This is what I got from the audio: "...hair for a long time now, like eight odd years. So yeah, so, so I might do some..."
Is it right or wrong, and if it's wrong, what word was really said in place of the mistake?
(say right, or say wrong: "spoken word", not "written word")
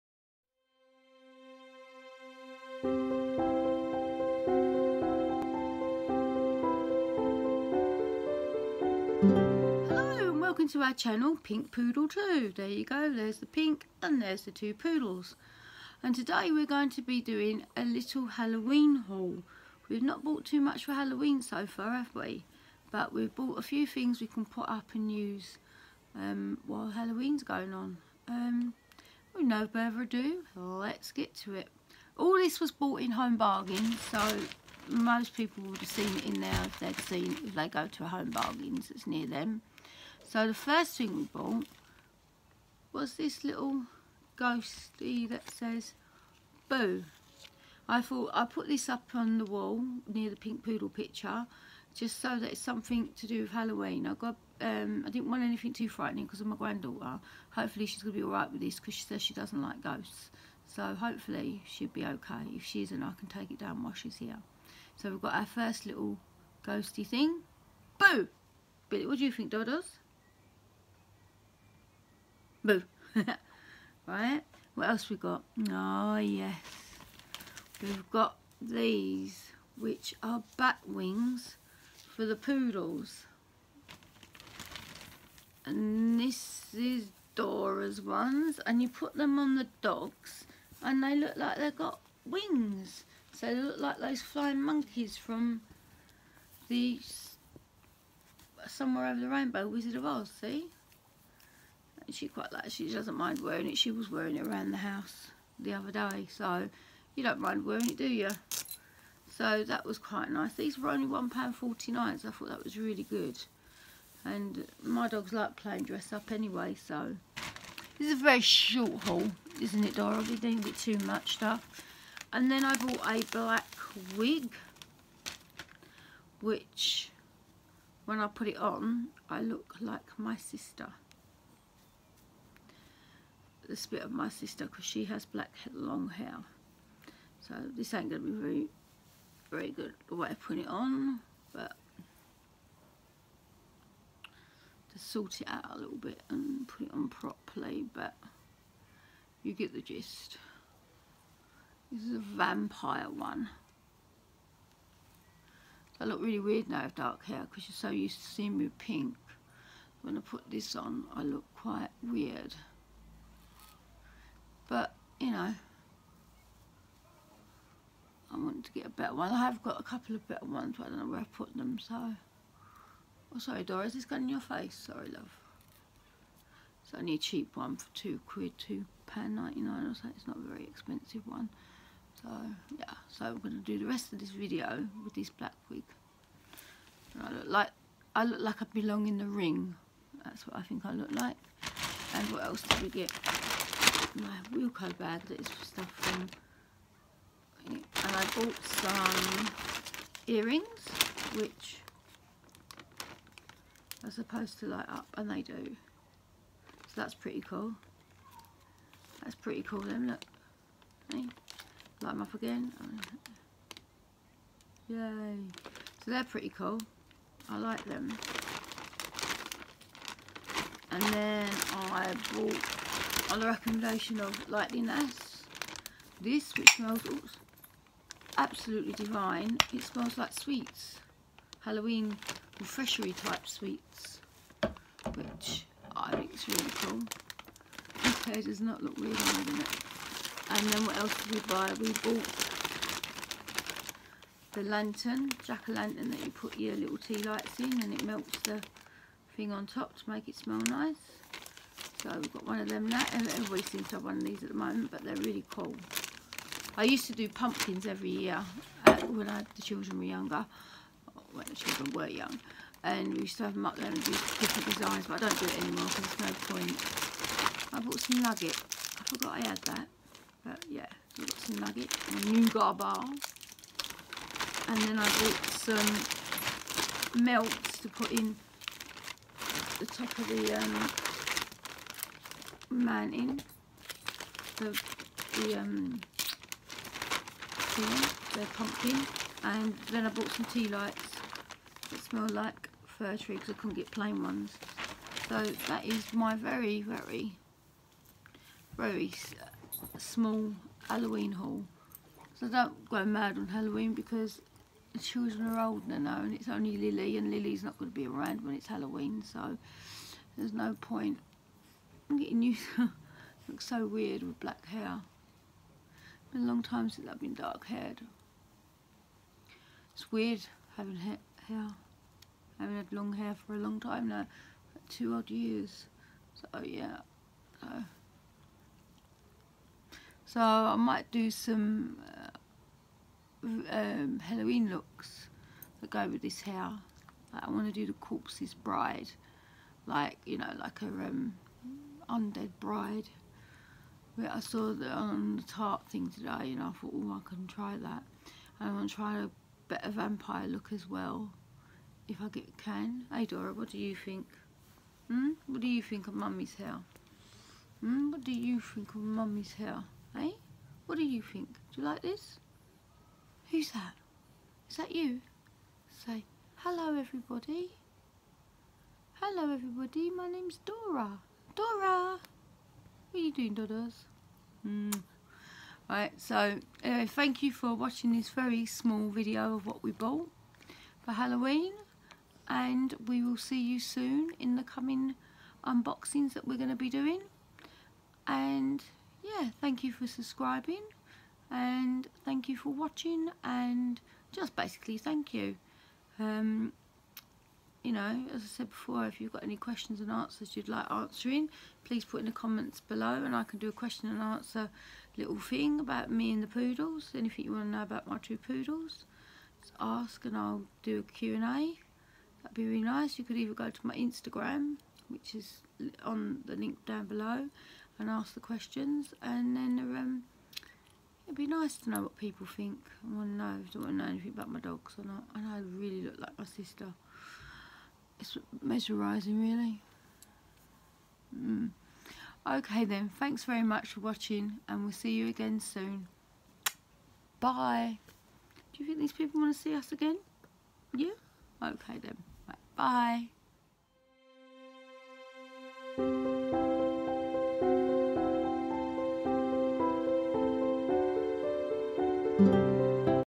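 wrong: "two", not "eight".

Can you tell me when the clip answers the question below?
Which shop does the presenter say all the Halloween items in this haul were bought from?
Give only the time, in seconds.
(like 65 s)
33 s.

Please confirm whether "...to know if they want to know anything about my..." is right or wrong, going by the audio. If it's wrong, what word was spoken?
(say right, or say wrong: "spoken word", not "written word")
right.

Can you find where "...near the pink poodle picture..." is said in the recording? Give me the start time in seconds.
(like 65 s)
50 s.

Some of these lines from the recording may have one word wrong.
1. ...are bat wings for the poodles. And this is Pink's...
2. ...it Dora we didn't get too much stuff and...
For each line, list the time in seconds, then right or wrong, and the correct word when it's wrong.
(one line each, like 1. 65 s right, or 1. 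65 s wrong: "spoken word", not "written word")
1. 80 s wrong: "Dora", not "Pink"
2. 119 s right.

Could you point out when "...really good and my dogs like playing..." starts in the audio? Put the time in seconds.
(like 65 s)
112 s.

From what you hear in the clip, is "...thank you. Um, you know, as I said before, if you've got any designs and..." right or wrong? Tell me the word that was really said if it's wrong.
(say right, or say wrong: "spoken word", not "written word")
wrong: "questions", not "designs".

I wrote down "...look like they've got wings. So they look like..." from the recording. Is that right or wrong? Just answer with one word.
right.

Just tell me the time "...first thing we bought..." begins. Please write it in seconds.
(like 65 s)
40 s.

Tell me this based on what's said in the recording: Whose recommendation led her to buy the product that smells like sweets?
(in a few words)
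Lightliness.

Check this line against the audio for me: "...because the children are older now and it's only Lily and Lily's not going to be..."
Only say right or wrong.
right.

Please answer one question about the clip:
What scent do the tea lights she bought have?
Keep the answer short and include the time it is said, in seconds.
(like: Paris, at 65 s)
Fir tree, at 292 s.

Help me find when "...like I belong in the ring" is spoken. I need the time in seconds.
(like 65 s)
188 s.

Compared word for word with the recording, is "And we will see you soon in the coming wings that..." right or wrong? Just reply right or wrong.
wrong.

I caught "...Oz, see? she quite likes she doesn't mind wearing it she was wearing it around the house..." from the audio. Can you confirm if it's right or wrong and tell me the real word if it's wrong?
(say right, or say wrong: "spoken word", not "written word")
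right.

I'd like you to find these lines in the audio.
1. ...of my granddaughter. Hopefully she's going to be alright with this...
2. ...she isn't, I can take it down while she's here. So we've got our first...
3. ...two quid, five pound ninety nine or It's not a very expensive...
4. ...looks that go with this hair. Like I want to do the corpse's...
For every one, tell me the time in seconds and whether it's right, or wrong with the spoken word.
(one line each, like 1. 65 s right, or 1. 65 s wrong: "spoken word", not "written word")
1. 56 s right
2. 62 s right
3. 177 s wrong: "two", not "five"
4. 334 s right.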